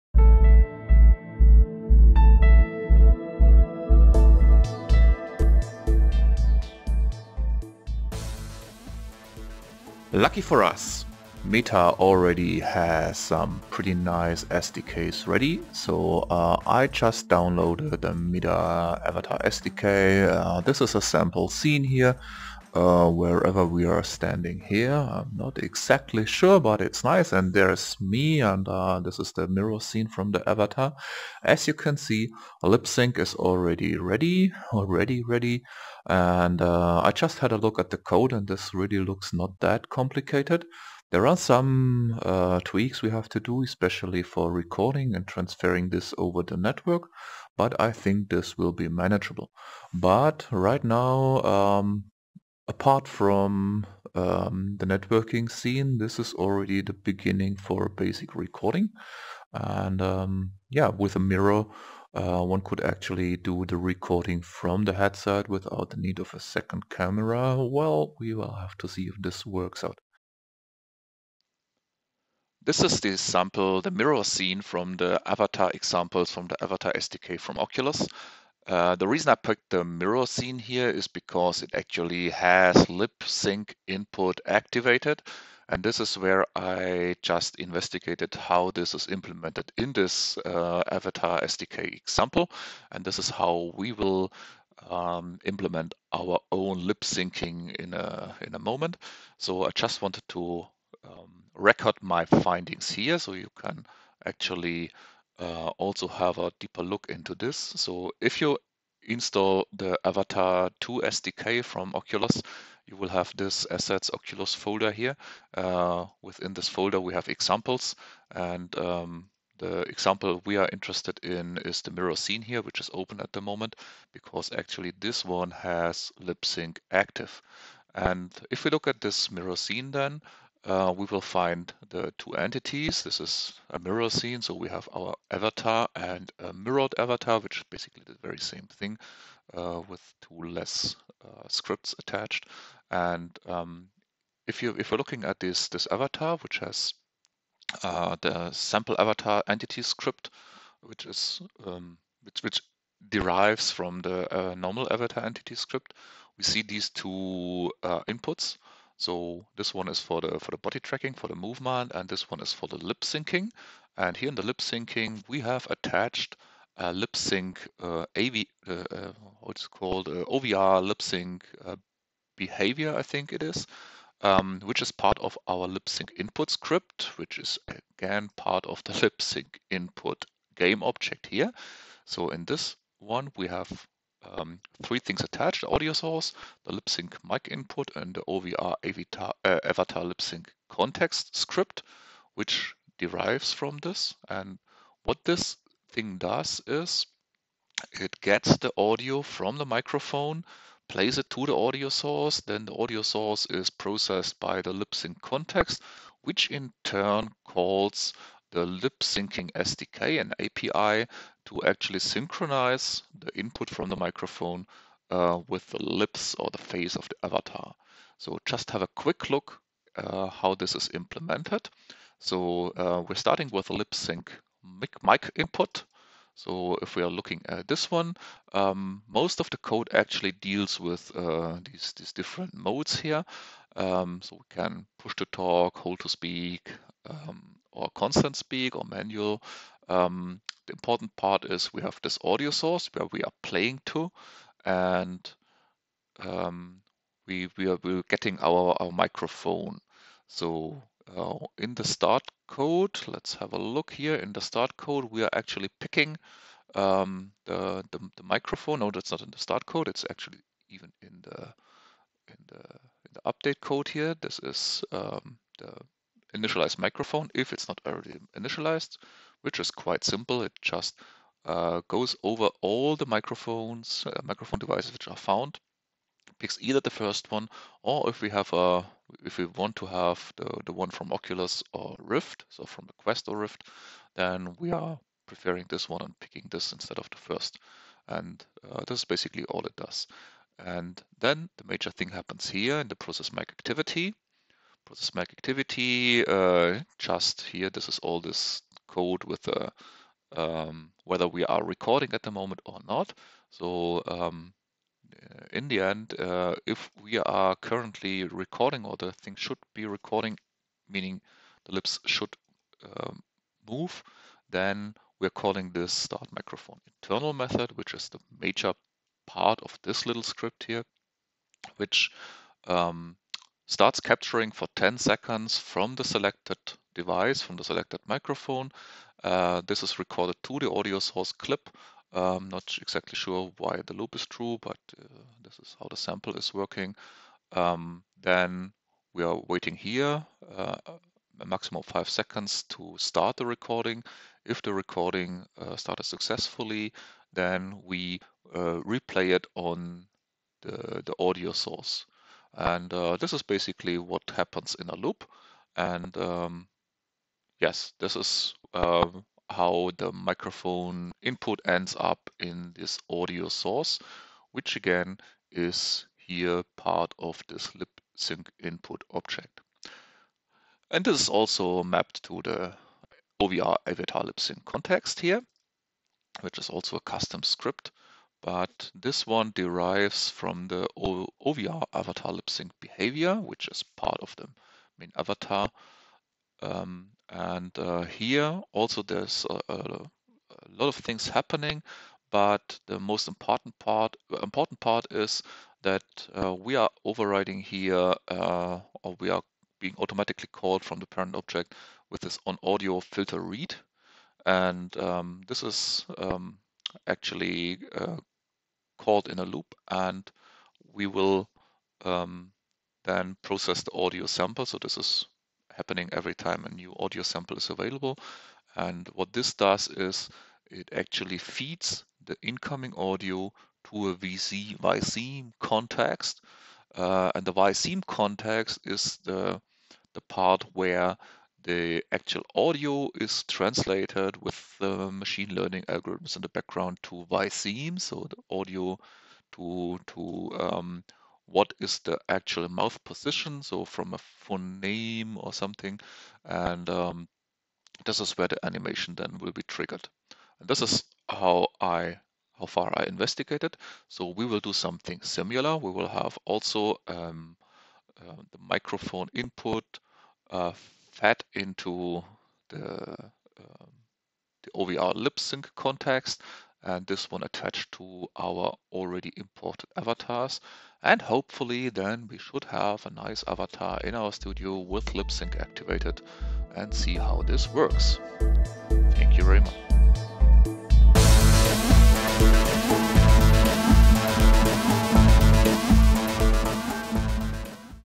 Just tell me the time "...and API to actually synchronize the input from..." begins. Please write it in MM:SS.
03:30.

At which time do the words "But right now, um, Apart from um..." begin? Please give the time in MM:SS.
00:49.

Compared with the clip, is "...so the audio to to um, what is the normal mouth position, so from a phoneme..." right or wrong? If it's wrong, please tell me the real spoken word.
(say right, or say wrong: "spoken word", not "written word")
wrong: "actual", not "normal".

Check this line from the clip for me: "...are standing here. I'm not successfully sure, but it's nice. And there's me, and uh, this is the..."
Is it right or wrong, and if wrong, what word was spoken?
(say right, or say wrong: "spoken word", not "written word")
wrong: "exactly", not "successfully".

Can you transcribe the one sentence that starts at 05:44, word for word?
If the recording uh, started successfully, then we uh, replay it on the, the audio source.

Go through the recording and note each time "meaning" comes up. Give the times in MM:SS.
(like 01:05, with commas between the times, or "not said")
05:10.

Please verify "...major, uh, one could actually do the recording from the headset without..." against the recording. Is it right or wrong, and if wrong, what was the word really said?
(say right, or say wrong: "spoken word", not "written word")
wrong: "mirror", not "major".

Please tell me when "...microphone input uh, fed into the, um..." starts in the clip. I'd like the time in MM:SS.
07:38.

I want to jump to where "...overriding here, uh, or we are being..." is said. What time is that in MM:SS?
06:37.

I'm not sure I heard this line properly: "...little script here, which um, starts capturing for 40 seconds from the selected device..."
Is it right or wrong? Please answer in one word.
wrong.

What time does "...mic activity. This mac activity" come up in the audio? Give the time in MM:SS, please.
04:53.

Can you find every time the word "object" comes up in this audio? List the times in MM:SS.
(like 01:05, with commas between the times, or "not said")
03:00, 06:09, 06:41.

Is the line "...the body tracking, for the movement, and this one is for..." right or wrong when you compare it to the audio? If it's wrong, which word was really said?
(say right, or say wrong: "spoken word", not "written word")
right.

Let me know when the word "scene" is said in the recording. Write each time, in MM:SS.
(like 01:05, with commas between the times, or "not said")
00:21, 00:29, 00:55, 01:14, 01:20, 02:02, 02:09, 02:14.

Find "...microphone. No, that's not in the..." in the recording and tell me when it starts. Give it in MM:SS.
04:18.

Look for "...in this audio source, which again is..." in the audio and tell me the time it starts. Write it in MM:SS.
06:02.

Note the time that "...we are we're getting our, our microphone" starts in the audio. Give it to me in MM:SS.
04:07.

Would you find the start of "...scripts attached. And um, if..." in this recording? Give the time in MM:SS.
02:21.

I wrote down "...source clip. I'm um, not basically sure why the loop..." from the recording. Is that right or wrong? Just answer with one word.
wrong.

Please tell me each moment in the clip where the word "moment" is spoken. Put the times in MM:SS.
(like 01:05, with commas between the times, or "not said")
01:38, 02:03, 05:02.